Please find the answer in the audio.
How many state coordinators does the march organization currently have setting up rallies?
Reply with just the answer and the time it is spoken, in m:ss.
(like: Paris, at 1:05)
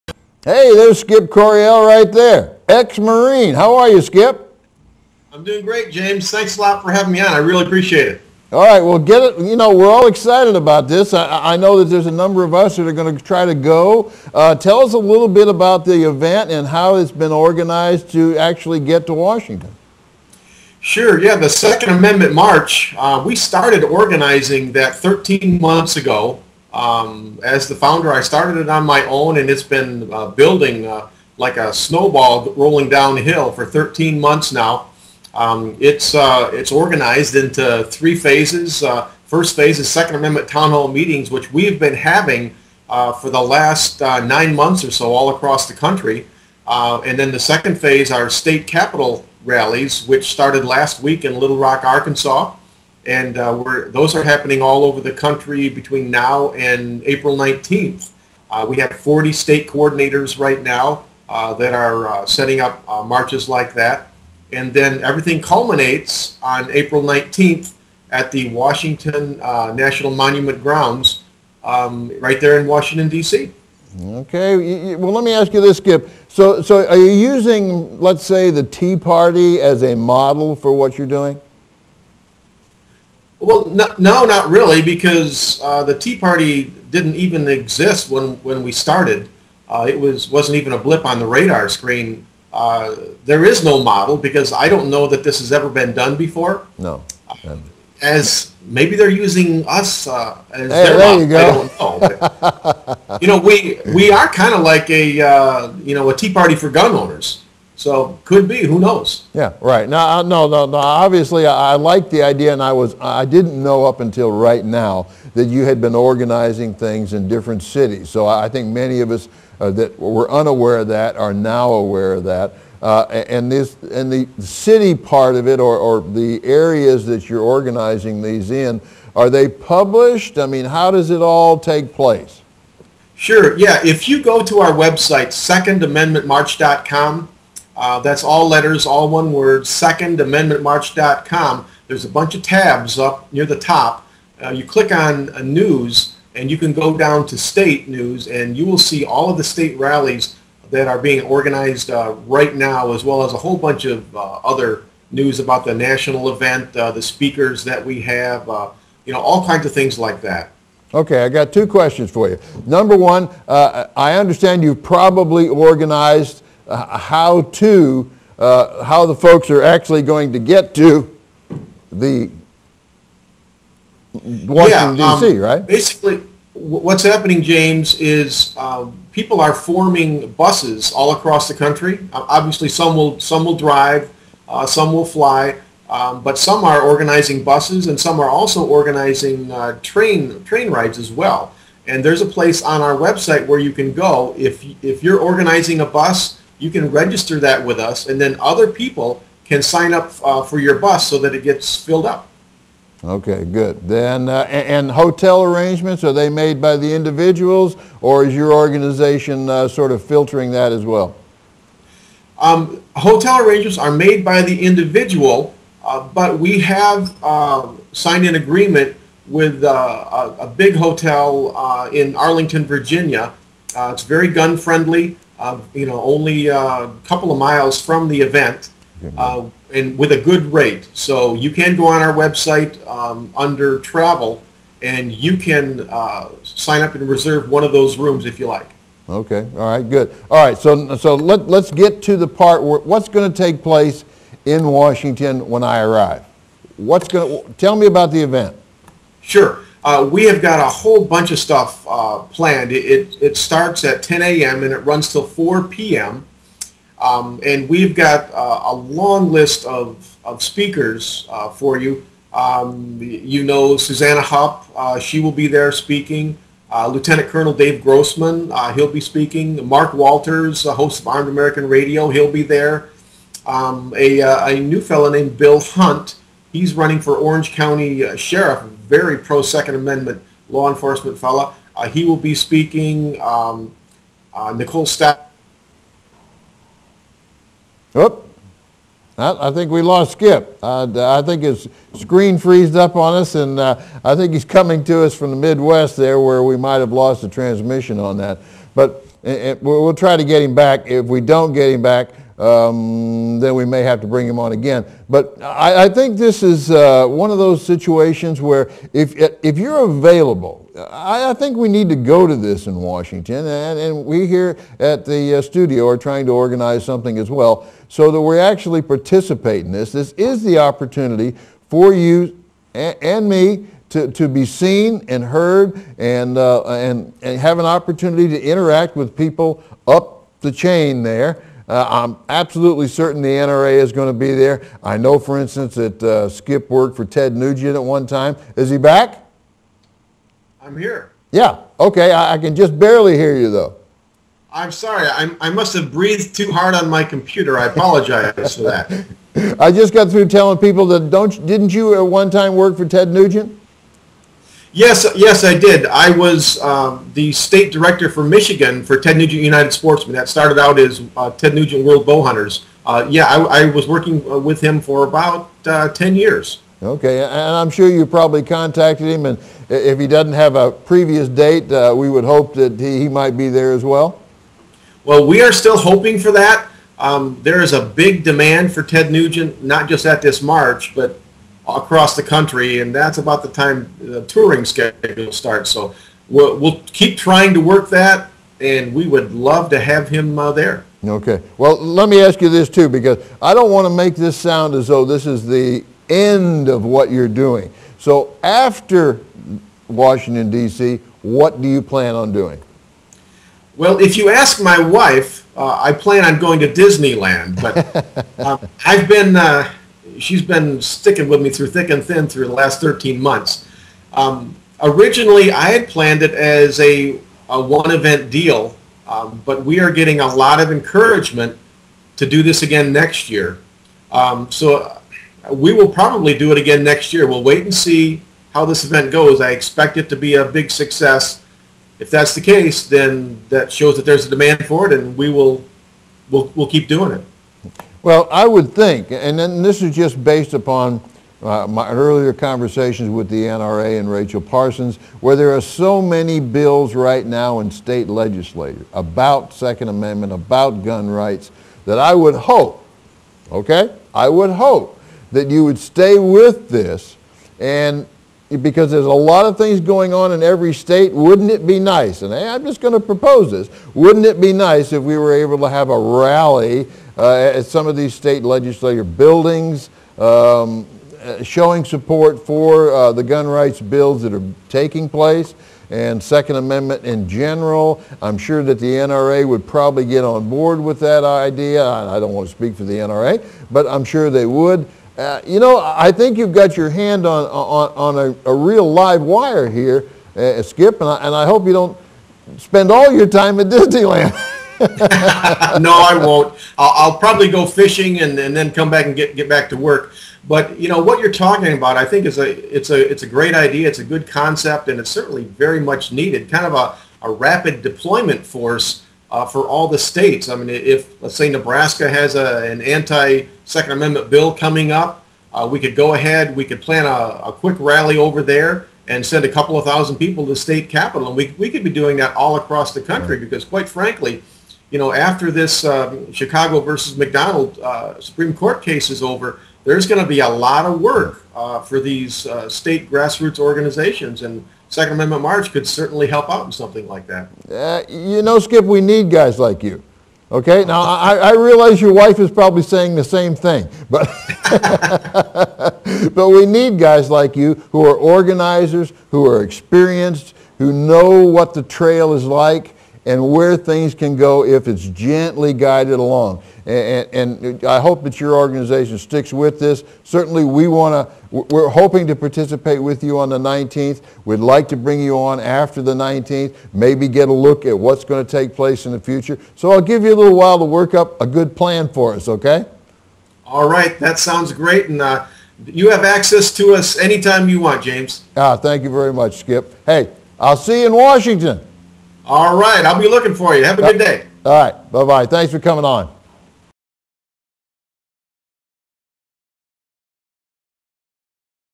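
40, at 0:58.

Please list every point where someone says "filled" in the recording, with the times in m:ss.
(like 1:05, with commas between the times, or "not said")
3:21.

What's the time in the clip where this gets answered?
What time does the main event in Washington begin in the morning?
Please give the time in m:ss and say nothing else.
4:14.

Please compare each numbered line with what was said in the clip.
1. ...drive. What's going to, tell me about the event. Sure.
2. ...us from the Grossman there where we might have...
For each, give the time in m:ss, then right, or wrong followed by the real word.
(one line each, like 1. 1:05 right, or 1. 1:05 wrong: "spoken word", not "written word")
1. 4:05 wrong: "arrive", not "drive"
2. 4:55 wrong: "Midwest", not "Grossman".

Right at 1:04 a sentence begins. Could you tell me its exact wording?
And then everything culminates on April 19th at the Washington uh, National Monument grounds um, right there in Washington, D.C.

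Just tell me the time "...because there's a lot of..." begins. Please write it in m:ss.
7:38.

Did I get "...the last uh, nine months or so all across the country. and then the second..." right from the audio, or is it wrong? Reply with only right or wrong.
right.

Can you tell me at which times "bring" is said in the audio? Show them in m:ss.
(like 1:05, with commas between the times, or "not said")
5:04, 9:24.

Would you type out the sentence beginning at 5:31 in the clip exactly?
Uh, I'm absolutely certain the NRA is going to be there.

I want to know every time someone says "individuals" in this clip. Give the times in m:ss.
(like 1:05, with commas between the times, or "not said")
3:26, 3:34.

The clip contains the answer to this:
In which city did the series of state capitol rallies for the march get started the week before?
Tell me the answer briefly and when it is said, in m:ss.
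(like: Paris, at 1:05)
Little Rock, Arkansas, at 0:51.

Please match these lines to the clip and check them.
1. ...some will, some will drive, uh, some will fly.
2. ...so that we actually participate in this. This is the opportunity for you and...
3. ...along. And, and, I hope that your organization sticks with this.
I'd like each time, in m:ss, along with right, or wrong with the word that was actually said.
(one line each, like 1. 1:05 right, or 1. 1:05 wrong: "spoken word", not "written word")
1. 3:02 right
2. 5:17 right
3. 9:16 right.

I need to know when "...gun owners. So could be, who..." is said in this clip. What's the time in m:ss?
1:46.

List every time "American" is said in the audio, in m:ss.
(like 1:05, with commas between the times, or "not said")
4:31.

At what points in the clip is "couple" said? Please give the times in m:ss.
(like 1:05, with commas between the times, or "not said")
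3:47, 8:39.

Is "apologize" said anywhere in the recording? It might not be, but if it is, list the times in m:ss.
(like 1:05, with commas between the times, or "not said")
5:47.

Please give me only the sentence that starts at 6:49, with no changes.
Uh, she's been sticking with me through thick and thin through the last 13 months.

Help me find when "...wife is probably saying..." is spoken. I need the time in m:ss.
9:02.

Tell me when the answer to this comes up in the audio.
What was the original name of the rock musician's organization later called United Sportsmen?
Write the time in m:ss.
6:01.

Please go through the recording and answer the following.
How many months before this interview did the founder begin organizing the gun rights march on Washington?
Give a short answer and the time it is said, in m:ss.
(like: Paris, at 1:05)
13, at 0:24.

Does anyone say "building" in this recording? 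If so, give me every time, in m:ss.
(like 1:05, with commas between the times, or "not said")
0:30, 7:49.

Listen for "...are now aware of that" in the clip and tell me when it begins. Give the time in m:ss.
2:01.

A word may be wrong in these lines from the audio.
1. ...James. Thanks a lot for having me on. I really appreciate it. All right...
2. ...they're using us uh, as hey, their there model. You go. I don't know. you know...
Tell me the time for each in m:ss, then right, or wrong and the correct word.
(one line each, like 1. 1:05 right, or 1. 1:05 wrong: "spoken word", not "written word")
1. 0:05 right
2. 1:38 right.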